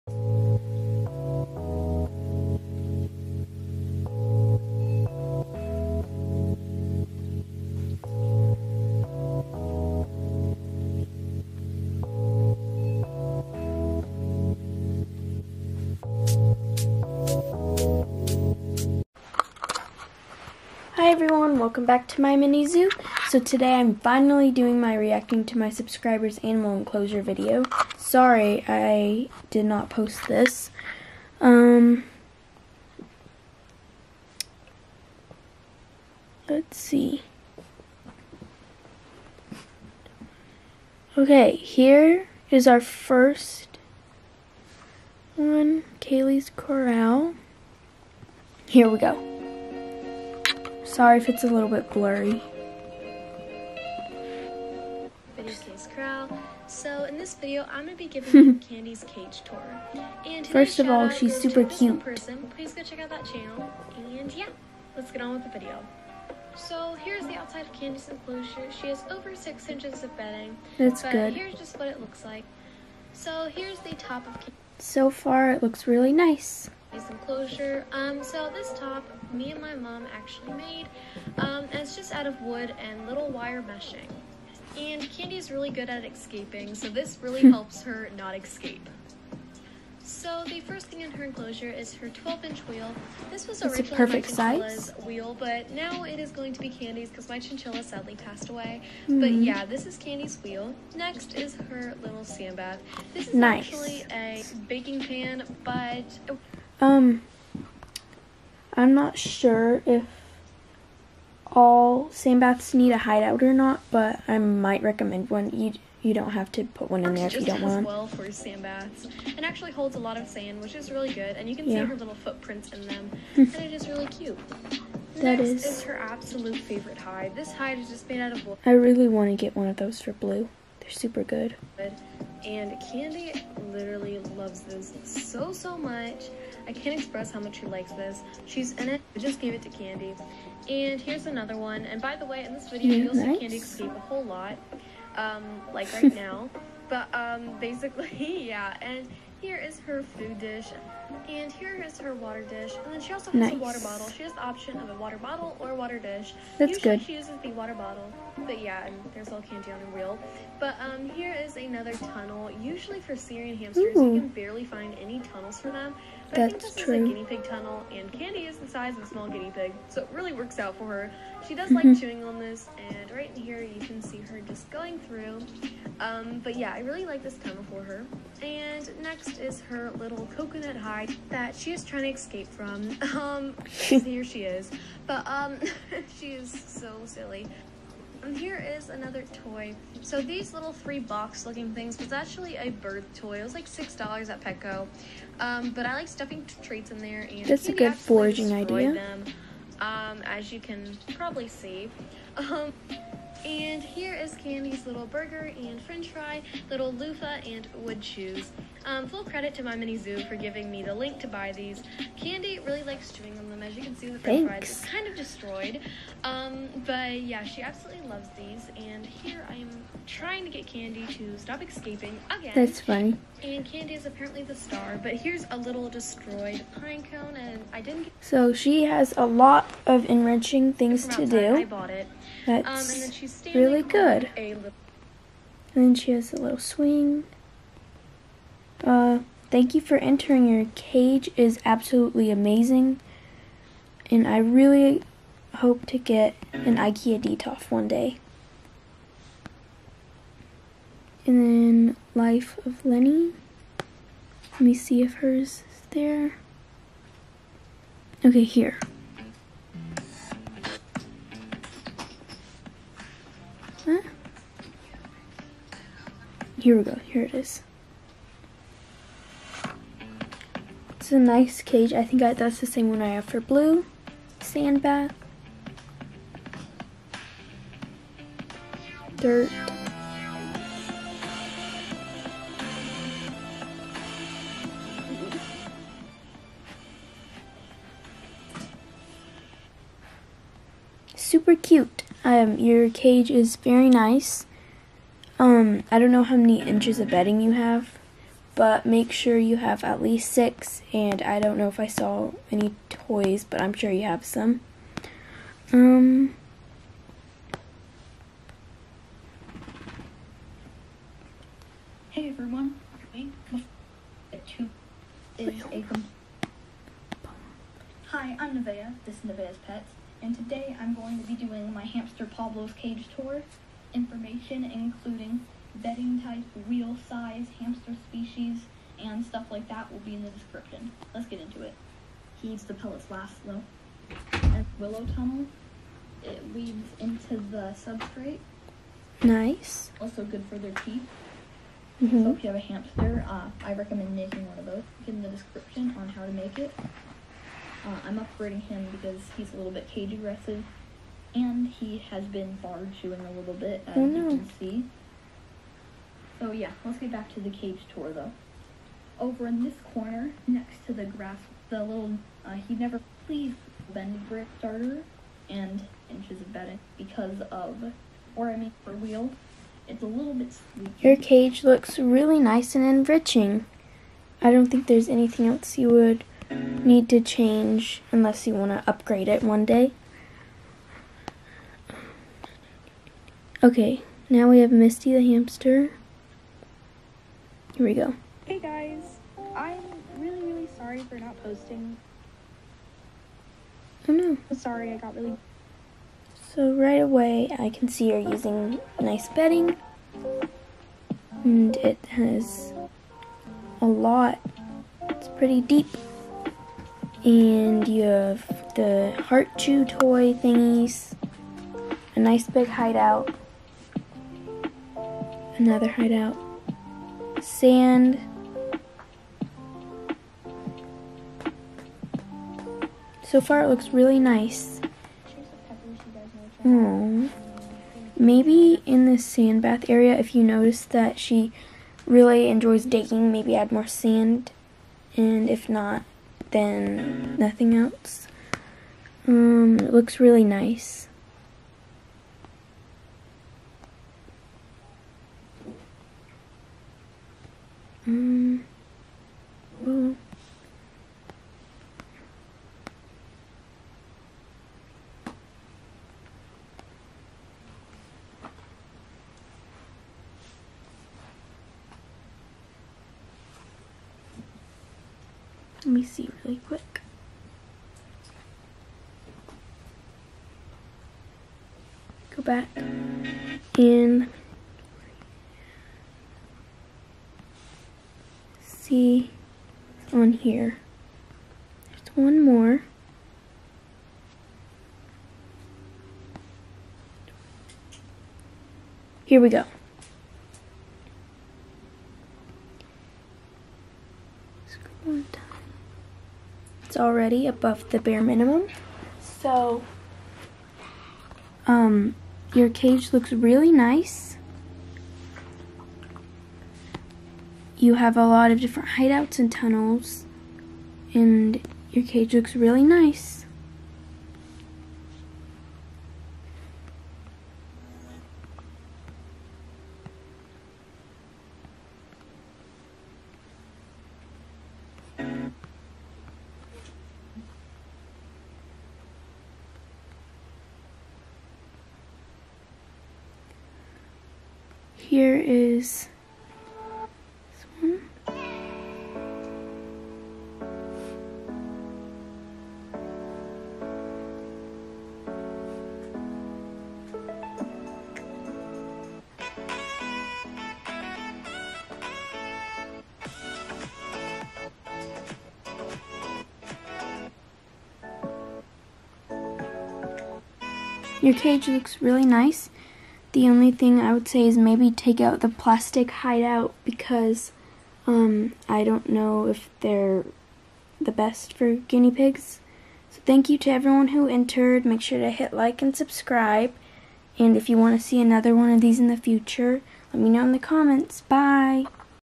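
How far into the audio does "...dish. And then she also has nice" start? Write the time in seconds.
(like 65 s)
152 s.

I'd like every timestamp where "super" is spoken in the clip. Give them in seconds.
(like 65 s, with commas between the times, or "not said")
61 s, 130 s, 291 s.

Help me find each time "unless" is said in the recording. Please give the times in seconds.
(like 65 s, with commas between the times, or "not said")
378 s.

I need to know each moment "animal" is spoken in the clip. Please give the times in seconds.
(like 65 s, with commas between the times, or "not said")
26 s.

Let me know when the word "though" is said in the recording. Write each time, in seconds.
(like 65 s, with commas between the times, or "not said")
333 s, 358 s.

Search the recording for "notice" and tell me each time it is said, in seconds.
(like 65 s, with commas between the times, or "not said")
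430 s.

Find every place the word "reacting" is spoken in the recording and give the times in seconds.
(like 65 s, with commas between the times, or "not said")
24 s.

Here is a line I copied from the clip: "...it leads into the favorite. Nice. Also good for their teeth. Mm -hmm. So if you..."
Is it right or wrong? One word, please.
wrong.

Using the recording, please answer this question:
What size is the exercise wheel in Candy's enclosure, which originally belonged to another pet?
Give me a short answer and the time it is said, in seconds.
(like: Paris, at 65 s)
12-inch, at 92 s.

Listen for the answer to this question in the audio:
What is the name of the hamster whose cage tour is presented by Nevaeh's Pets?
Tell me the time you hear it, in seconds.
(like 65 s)
322 s.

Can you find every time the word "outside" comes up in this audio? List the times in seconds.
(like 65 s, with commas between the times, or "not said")
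67 s.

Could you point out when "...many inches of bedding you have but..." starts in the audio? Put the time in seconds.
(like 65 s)
296 s.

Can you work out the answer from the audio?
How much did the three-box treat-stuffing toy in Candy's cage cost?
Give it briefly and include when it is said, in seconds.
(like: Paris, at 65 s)
6 dollars, at 193 s.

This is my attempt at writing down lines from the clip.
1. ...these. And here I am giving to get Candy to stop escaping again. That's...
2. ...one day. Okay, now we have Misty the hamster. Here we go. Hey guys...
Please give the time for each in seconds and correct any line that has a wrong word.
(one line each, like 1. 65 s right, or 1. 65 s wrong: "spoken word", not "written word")
1. 218 s wrong: "trying", not "giving"
2. 379 s right.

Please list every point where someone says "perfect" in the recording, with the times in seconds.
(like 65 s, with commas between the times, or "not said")
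93 s.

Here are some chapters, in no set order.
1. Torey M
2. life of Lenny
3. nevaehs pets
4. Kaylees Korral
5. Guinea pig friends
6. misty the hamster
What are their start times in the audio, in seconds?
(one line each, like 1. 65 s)
1. 493 s
2. 268 s
3. 308 s
4. 46 s
5. 530 s
6. 386 s.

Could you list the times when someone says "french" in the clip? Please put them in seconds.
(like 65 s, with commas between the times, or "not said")
205 s, 214 s.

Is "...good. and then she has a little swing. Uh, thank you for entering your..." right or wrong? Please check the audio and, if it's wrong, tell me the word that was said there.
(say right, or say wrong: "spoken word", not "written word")
right.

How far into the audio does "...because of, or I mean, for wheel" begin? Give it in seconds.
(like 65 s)
366 s.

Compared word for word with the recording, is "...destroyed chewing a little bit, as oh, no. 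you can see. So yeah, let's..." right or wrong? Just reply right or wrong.
wrong.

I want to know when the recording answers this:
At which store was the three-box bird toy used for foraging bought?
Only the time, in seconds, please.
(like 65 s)
194 s.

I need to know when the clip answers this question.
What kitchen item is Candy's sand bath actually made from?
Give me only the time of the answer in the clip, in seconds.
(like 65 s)
104 s.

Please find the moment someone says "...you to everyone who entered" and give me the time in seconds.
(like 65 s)
573 s.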